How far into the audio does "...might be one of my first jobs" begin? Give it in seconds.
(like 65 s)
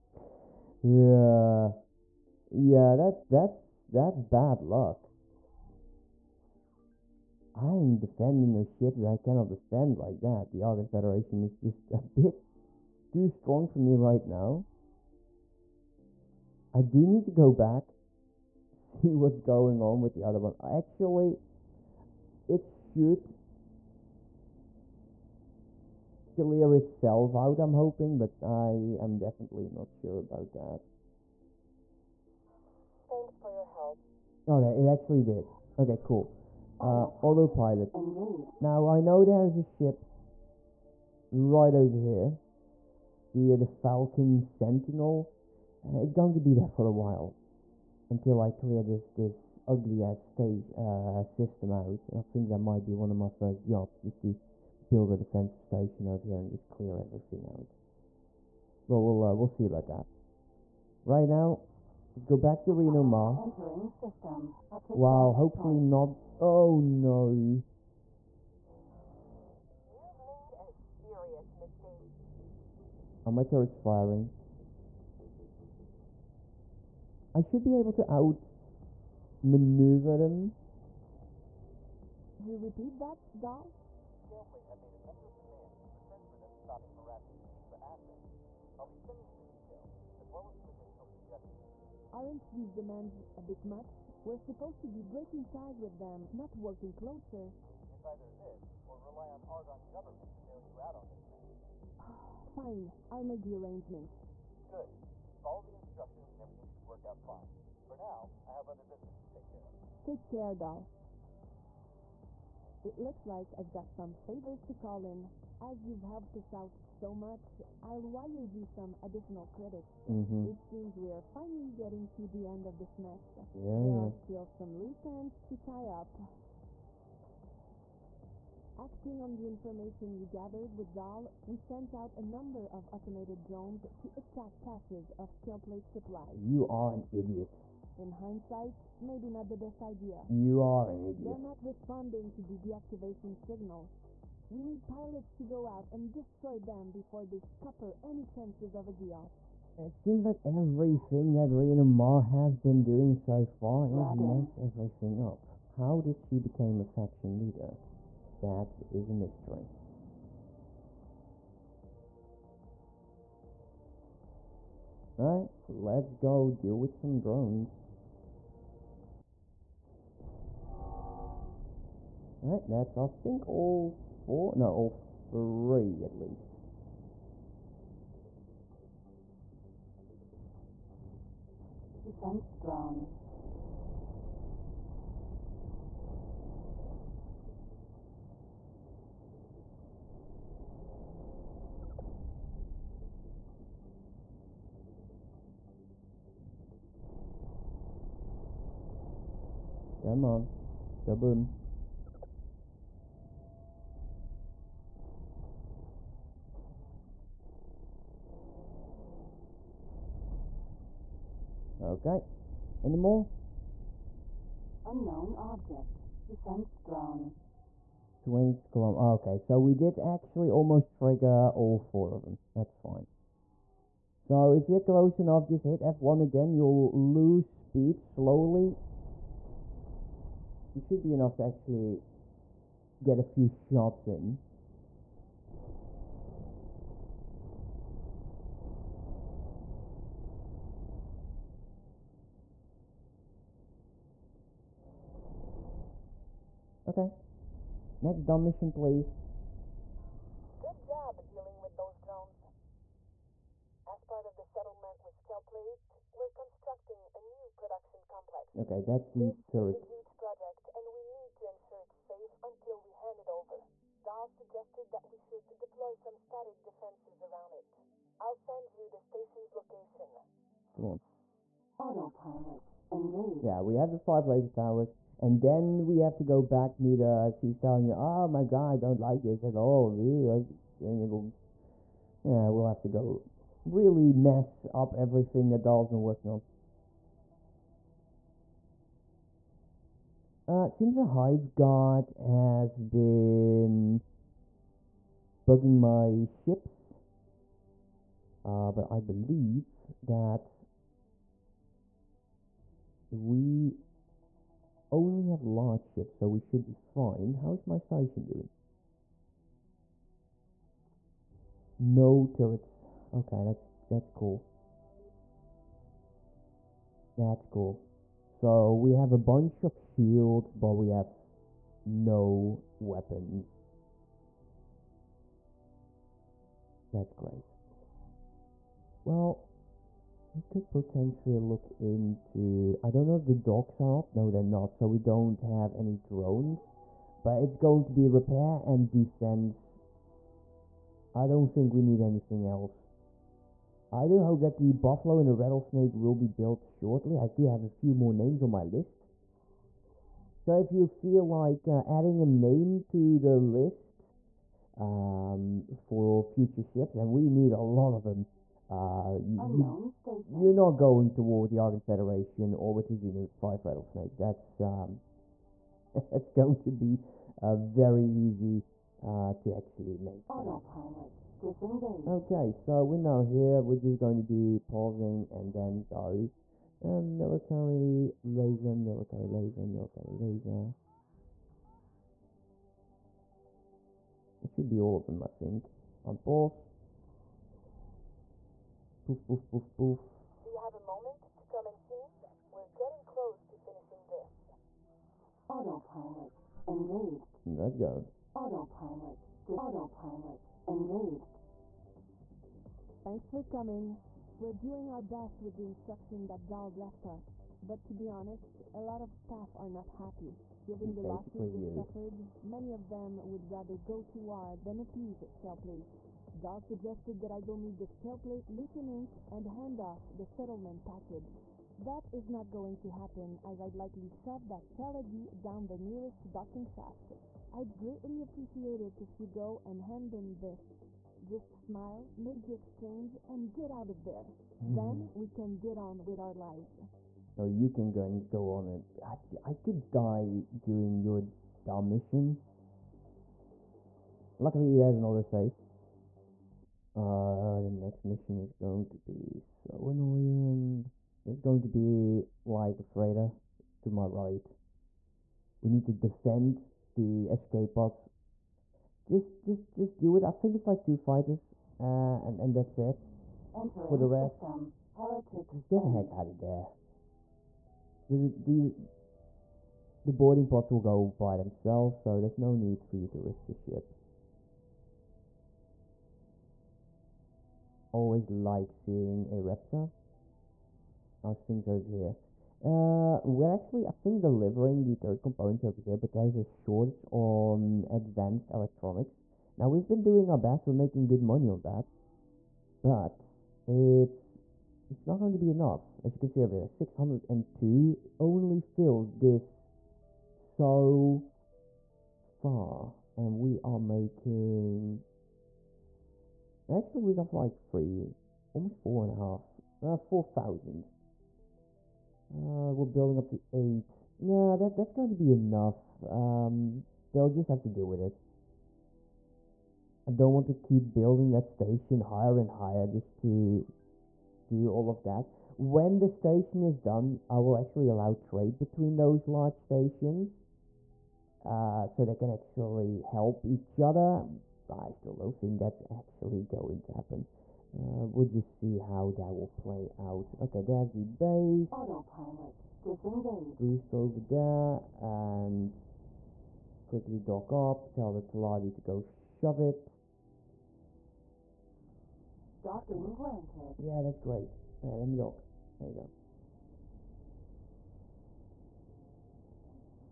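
52 s.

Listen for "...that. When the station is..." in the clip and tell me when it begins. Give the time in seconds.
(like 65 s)
525 s.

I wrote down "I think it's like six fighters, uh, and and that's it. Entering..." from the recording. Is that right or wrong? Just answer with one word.
wrong.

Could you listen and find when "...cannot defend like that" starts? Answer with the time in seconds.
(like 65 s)
9 s.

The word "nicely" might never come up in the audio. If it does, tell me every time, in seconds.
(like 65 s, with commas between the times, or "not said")
not said.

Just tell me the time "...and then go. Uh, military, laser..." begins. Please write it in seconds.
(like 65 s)
375 s.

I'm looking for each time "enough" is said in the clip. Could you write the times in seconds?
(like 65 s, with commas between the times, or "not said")
225 s, 231 s, 495 s, 515 s.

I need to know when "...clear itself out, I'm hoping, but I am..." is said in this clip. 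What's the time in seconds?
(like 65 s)
26 s.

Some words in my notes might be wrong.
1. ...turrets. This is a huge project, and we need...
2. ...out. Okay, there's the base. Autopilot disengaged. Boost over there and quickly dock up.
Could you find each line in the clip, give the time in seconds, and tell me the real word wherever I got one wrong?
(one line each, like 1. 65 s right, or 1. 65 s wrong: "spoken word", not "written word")
1. 259 s right
2. 539 s right.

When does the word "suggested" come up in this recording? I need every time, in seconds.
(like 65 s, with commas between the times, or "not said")
264 s, 416 s.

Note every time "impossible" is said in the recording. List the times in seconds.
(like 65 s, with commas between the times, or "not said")
not said.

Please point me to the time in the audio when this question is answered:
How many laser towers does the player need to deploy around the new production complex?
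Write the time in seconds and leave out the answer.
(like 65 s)
273 s.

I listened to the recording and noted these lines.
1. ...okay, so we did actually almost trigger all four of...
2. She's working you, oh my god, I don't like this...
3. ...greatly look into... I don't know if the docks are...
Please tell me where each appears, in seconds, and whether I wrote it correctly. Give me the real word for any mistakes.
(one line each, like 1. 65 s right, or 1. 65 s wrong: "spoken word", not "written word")
1. 219 s right
2. 277 s wrong: "telling", not "working"
3. 330 s wrong: "potentially", not "greatly".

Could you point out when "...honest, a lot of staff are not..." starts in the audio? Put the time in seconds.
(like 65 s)
408 s.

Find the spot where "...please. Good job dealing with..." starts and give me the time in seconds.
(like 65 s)
248 s.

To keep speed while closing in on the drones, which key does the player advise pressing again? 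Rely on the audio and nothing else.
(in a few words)
F1.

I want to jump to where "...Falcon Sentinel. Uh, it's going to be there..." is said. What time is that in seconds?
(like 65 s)
43 s.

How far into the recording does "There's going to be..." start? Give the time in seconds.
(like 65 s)
451 s.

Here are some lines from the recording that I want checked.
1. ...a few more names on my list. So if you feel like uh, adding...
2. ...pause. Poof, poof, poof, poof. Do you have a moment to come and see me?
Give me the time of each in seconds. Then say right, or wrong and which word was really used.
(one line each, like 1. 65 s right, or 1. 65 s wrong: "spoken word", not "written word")
1. 347 s right
2. 386 s right.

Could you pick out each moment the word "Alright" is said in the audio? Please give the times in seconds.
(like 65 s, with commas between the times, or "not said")
165 s, 172 s.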